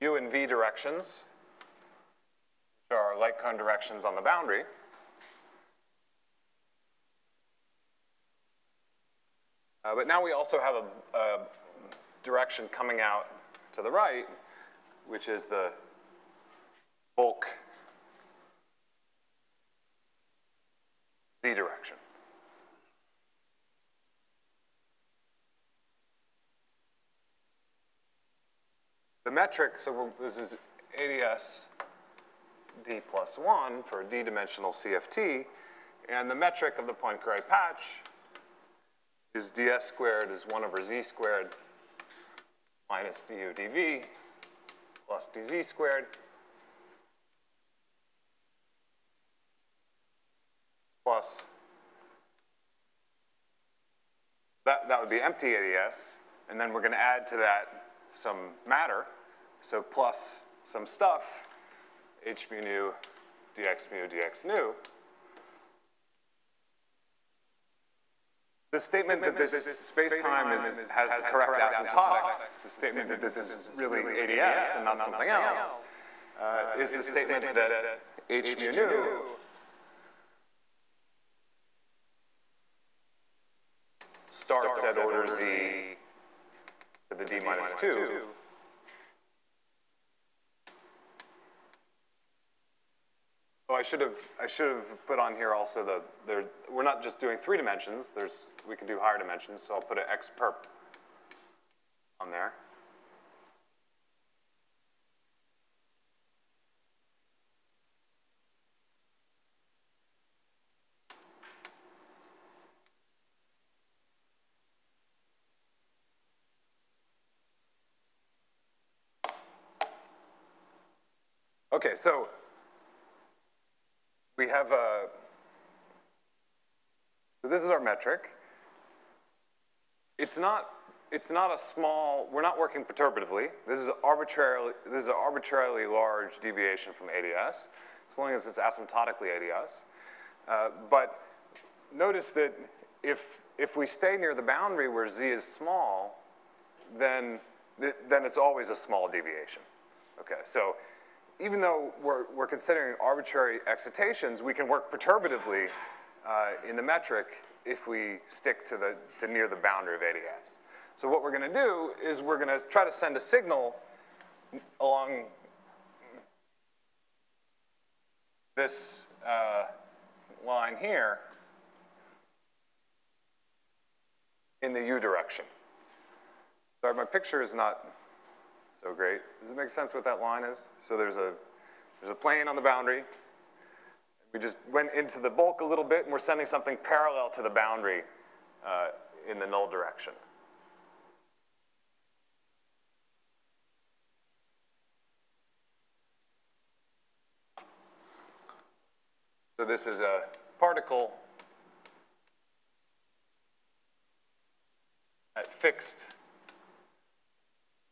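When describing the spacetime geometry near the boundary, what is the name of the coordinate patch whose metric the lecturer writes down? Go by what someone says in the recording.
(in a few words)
Poincare patch.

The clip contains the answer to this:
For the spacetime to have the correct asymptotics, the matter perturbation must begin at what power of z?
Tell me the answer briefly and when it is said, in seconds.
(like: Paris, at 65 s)
z to the d minus 2, at 85 s.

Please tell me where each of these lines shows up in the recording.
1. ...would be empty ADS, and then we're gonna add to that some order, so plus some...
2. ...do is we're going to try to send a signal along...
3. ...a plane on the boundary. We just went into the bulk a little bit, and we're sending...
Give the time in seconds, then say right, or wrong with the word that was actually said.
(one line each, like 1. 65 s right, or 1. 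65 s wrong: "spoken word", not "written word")
1. 54 s wrong: "matter", not "order"
2. 161 s right
3. 182 s right.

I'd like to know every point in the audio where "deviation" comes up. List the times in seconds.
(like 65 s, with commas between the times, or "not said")
136 s, 149 s.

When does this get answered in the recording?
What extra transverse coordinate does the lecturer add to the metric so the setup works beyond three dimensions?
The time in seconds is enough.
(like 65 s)
100 s.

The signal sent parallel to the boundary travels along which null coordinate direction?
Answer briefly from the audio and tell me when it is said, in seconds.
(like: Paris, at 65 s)
u direction, at 174 s.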